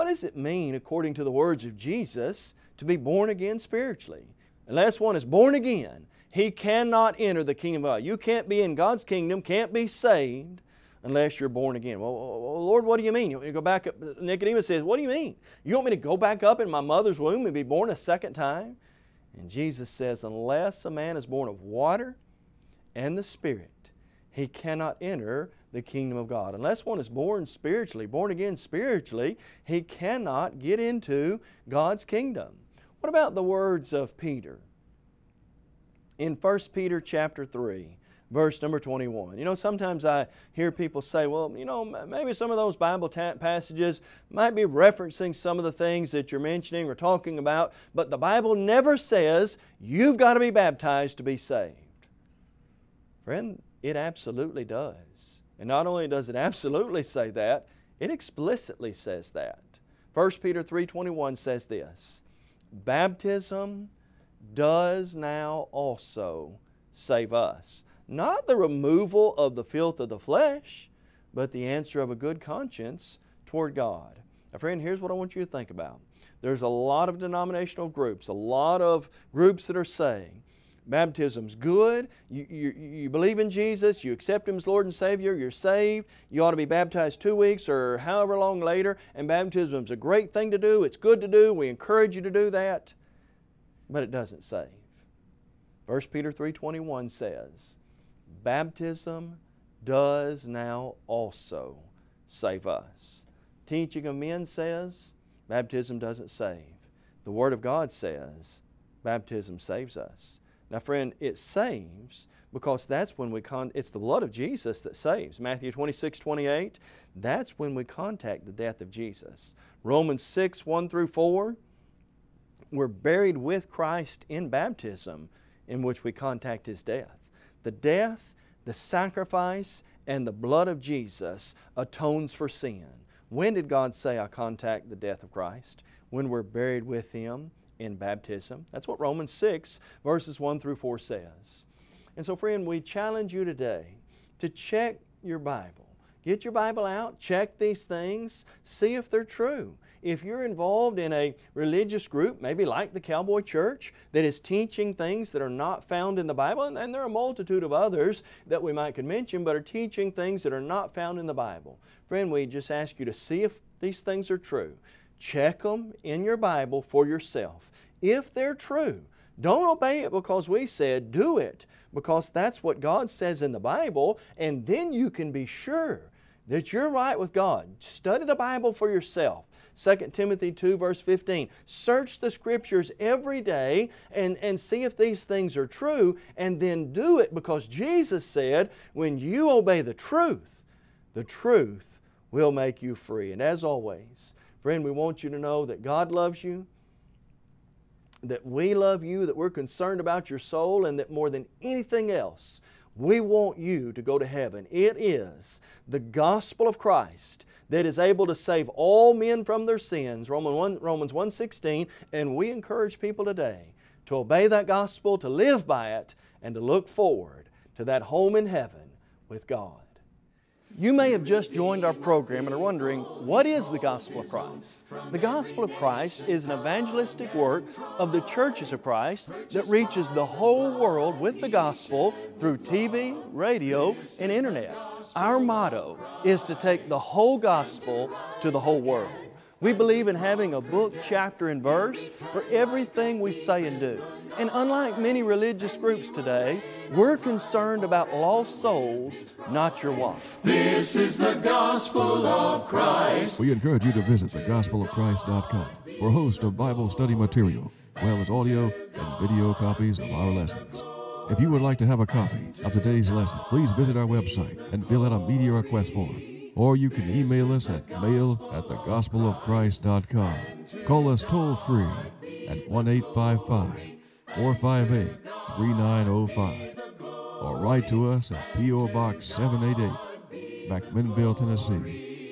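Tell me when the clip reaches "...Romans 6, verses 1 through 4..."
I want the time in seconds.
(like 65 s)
139 s.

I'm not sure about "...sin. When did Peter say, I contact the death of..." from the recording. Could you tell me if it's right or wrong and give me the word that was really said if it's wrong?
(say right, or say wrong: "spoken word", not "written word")
wrong: "God", not "Peter".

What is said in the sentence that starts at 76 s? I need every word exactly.
There's a lot of denominational groups, a lot of groups that are saying, Baptism's good.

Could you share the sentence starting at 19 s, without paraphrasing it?
And Jesus says, Unless a man is born of water and the Spirit, he cannot enter the kingdom of God.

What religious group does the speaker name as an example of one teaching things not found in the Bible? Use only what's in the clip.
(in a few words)
Cowboy Church.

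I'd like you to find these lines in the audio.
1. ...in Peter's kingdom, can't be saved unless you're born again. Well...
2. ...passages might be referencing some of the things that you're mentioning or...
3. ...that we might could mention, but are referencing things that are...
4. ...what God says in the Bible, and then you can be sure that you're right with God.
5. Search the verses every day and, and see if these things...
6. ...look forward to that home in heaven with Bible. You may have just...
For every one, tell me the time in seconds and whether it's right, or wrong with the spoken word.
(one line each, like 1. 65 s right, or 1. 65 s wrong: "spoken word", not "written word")
1. 8 s wrong: "God", not "Peter"
2. 43 s right
3. 158 s wrong: "teaching", not "referencing"
4. 172 s right
5. 181 s wrong: "scriptures", not "verses"
6. 216 s wrong: "God", not "Bible".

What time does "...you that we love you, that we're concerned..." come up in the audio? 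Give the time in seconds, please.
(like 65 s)
196 s.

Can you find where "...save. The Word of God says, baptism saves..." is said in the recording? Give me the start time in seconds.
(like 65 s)
106 s.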